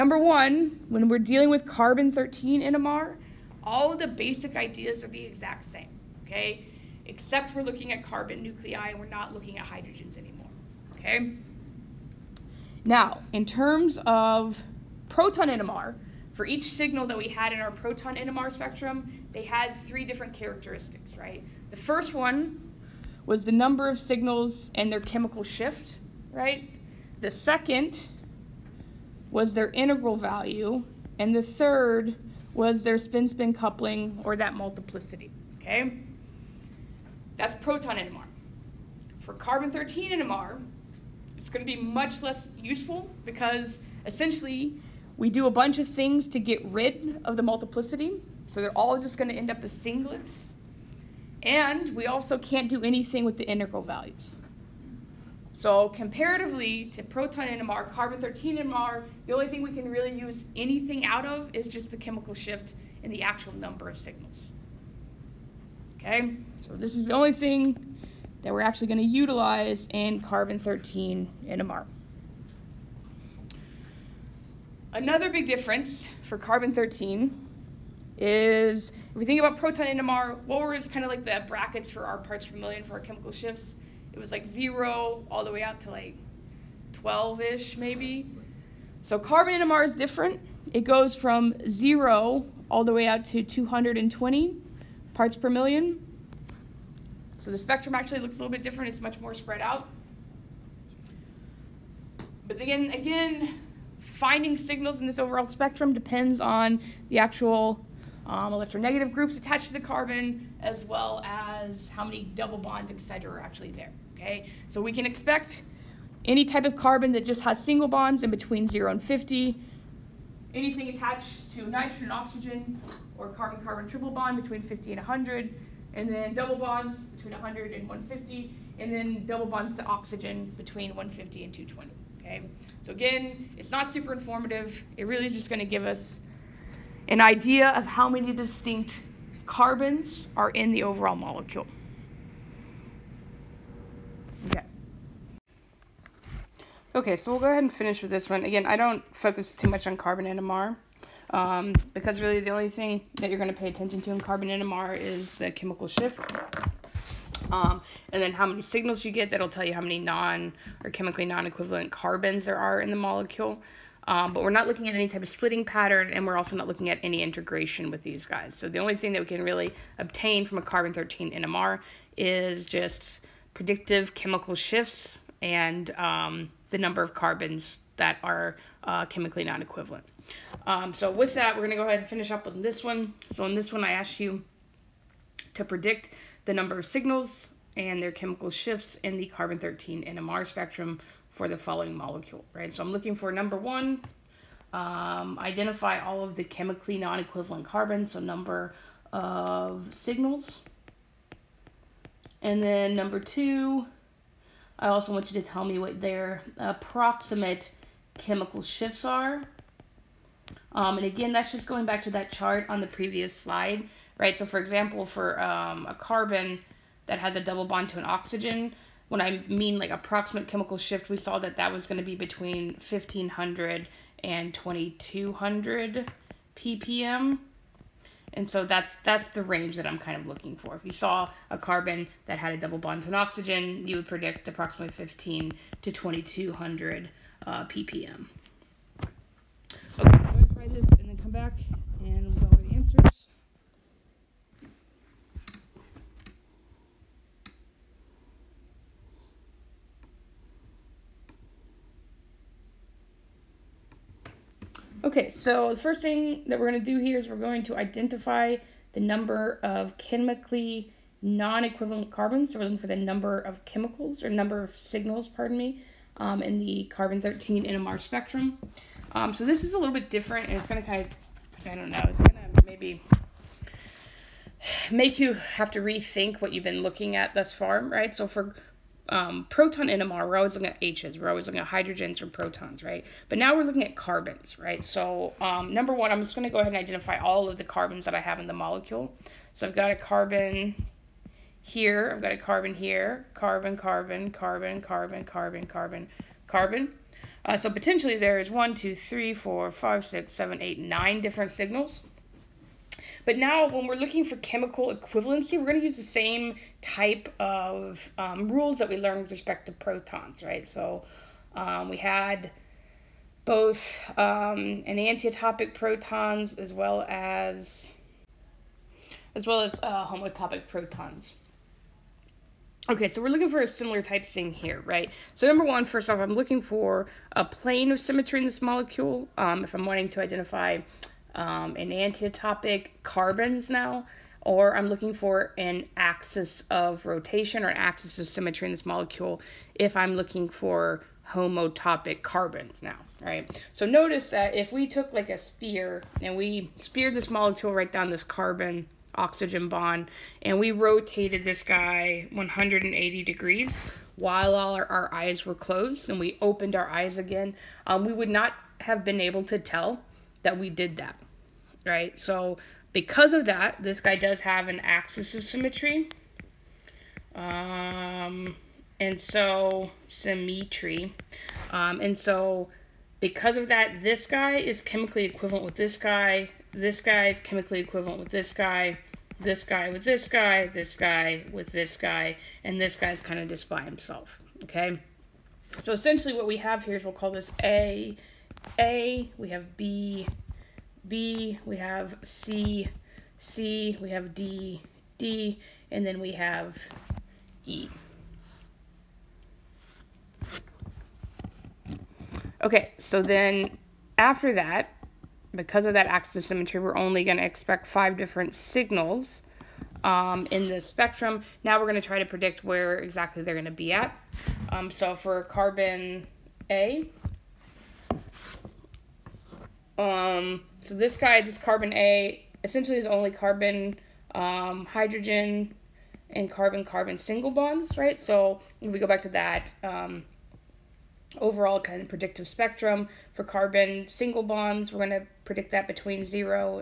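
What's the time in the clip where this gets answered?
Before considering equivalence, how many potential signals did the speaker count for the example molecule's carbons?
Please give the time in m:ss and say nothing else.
5:00.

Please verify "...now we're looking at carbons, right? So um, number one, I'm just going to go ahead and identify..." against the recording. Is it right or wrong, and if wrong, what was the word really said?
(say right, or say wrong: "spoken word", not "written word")
right.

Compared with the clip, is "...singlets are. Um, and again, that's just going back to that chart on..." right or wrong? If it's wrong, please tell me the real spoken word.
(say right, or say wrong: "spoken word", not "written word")
wrong: "shifts", not "singlets".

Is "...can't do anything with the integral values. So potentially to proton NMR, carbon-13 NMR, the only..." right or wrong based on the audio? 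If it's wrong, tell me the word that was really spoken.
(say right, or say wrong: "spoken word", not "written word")
wrong: "comparatively", not "potentially".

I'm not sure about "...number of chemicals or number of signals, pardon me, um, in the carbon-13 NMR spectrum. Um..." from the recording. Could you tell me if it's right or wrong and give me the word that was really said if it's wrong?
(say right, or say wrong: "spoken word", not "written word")
right.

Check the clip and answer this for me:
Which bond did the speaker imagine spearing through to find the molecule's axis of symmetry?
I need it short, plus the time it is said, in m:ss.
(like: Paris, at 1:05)
carbon oxygen bond, at 5:48.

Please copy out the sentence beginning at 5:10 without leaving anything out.
So um, we had both um, enantiotopic protons as well as as well as uh, homotopic protons.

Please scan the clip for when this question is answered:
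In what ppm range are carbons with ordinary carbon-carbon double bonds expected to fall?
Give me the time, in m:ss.
2:07.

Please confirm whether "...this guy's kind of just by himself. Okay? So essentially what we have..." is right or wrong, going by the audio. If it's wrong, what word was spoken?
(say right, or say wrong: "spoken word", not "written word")
right.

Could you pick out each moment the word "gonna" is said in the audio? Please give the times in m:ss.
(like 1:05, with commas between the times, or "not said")
0:41, 0:49, 2:15.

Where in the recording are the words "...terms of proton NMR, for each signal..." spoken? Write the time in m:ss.
0:13.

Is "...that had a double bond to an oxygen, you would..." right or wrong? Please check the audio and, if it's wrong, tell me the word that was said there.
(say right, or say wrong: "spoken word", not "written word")
right.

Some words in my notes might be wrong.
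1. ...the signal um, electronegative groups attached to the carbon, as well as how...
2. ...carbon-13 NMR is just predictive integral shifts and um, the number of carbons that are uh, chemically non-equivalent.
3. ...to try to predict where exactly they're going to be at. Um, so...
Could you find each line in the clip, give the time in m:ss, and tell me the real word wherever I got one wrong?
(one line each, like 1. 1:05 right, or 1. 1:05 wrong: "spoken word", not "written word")
1. 1:47 wrong: "actual", not "signal"
2. 2:50 wrong: "chemical", not "integral"
3. 6:52 right.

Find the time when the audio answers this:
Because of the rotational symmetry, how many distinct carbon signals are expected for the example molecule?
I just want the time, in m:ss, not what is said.
6:47.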